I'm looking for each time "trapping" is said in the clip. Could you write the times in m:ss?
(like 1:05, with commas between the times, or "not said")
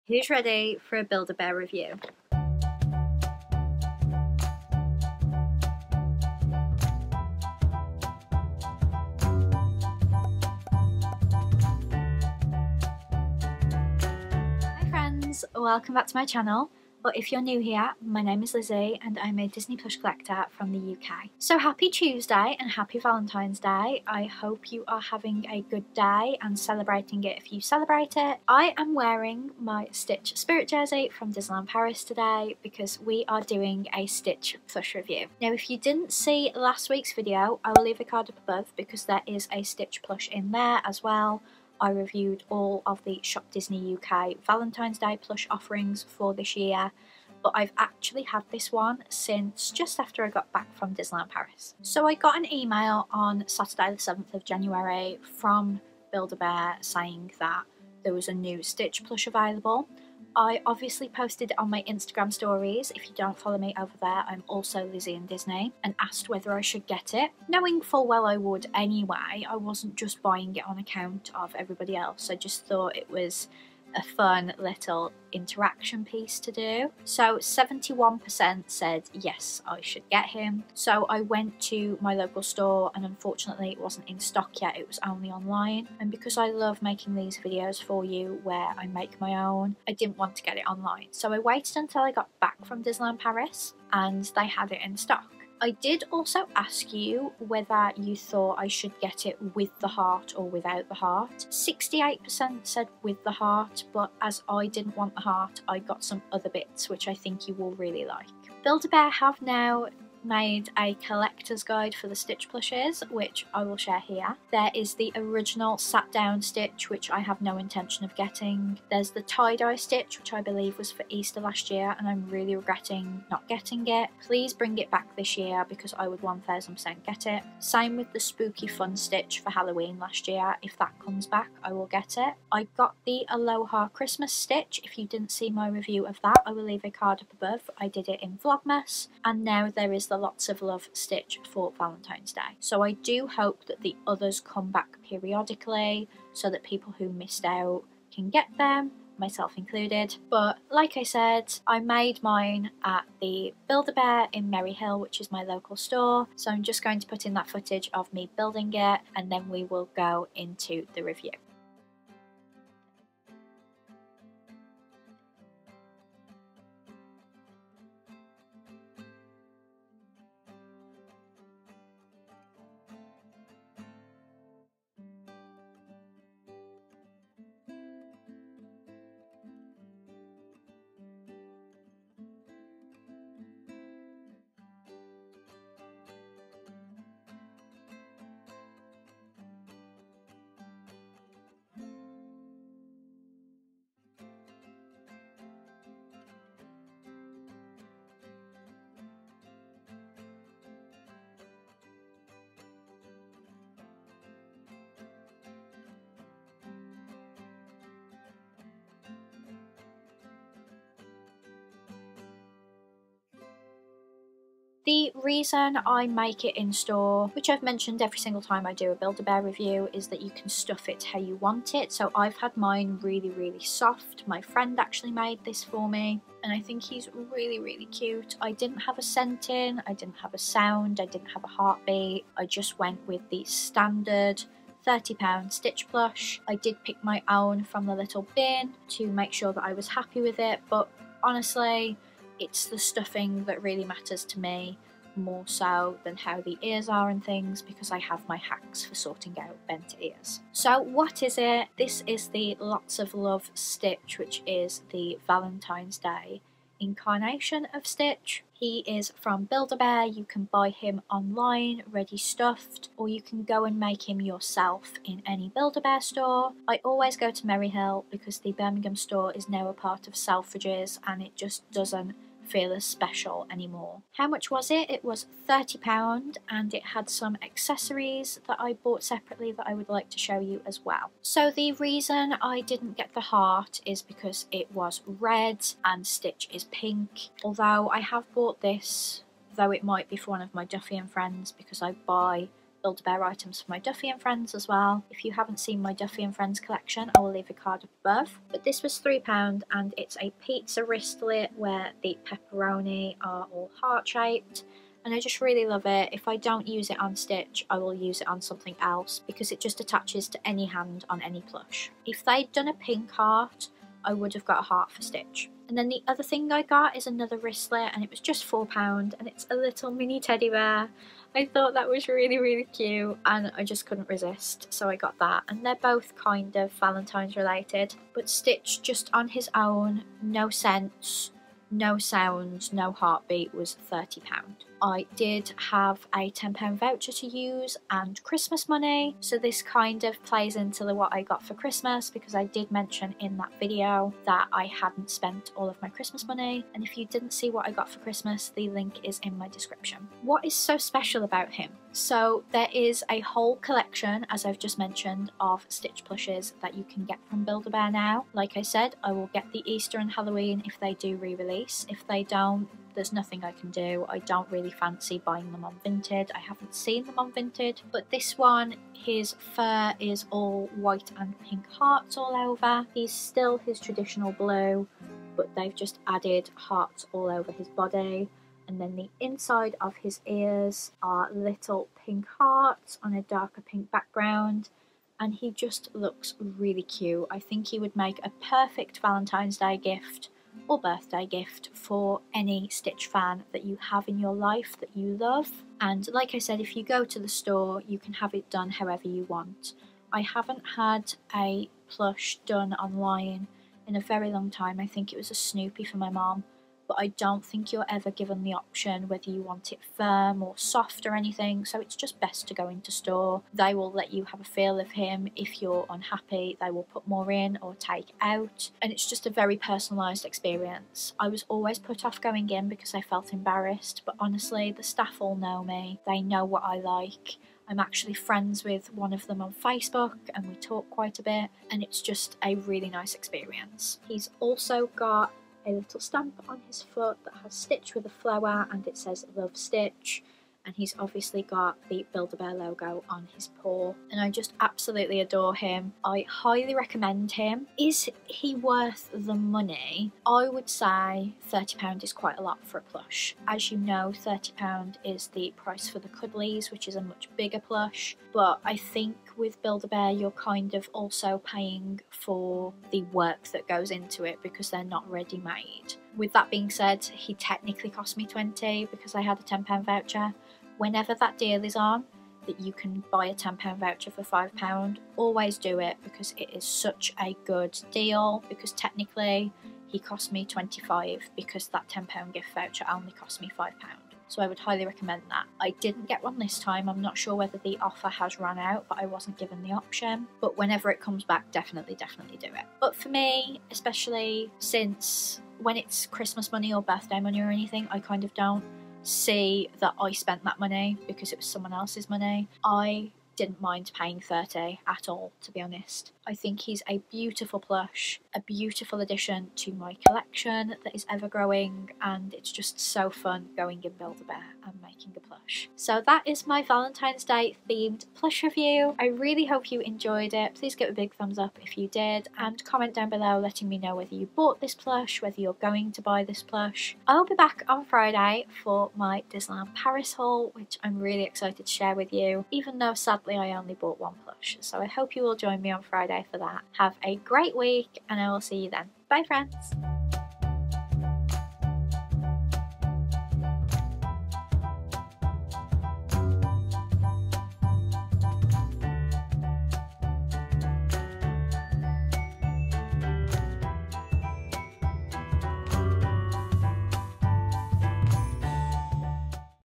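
not said.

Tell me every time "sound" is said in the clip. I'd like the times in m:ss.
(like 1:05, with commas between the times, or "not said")
3:50, 5:31.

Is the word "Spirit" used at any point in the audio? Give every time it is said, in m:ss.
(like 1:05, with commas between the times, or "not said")
0:30.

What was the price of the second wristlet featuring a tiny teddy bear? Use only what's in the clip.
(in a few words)
£4.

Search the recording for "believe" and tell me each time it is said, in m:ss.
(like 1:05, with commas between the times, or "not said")
2:00.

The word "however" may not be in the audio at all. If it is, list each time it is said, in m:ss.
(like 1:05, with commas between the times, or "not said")
6:38.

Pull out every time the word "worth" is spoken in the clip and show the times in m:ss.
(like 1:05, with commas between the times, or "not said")
7:28.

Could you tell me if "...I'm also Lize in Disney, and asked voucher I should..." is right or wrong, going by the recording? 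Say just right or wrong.
wrong.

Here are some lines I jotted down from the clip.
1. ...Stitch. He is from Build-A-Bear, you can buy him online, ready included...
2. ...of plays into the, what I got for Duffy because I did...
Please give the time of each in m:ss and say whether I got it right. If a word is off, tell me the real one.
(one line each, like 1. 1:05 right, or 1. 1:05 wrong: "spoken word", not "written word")
1. 4:17 wrong: "stuffed", not "included"
2. 5:40 wrong: "Christmas", not "Duffy".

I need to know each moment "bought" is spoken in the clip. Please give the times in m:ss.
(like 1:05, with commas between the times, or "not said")
4:38, 4:48, 8:44, 8:53.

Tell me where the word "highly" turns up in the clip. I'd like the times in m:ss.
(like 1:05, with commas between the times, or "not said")
7:26, 8:04.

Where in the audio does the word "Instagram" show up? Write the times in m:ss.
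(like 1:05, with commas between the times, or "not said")
1:01.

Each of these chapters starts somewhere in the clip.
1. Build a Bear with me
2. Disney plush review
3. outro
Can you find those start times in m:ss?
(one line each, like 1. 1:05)
1. 2:36
2. 3:46
3. 8:38.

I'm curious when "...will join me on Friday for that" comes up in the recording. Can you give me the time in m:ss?
8:55.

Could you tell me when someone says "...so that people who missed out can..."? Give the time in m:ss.
2:26.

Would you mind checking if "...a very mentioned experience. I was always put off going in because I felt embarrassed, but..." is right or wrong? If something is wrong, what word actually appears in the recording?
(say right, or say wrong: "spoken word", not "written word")
wrong: "personalised", not "mentioned".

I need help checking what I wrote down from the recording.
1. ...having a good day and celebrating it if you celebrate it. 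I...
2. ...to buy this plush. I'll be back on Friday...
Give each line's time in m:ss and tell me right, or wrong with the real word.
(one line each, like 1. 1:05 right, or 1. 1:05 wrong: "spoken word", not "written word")
1. 0:25 right
2. 8:45 right.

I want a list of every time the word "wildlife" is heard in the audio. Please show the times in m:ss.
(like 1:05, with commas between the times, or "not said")
not said.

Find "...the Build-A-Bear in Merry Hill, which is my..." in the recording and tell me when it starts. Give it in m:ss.
2:33.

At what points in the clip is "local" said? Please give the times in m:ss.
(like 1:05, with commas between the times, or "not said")
1:22, 2:35.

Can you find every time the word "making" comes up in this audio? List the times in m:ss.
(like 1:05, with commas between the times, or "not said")
1:26, 8:34.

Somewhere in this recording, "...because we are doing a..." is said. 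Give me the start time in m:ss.
0:32.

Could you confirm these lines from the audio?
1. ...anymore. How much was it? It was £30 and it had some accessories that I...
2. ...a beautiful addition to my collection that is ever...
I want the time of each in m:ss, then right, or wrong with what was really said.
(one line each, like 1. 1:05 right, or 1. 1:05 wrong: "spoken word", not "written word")
1. 4:33 right
2. 8:28 right.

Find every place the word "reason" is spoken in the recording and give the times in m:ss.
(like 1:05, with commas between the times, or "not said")
3:35, 4:41.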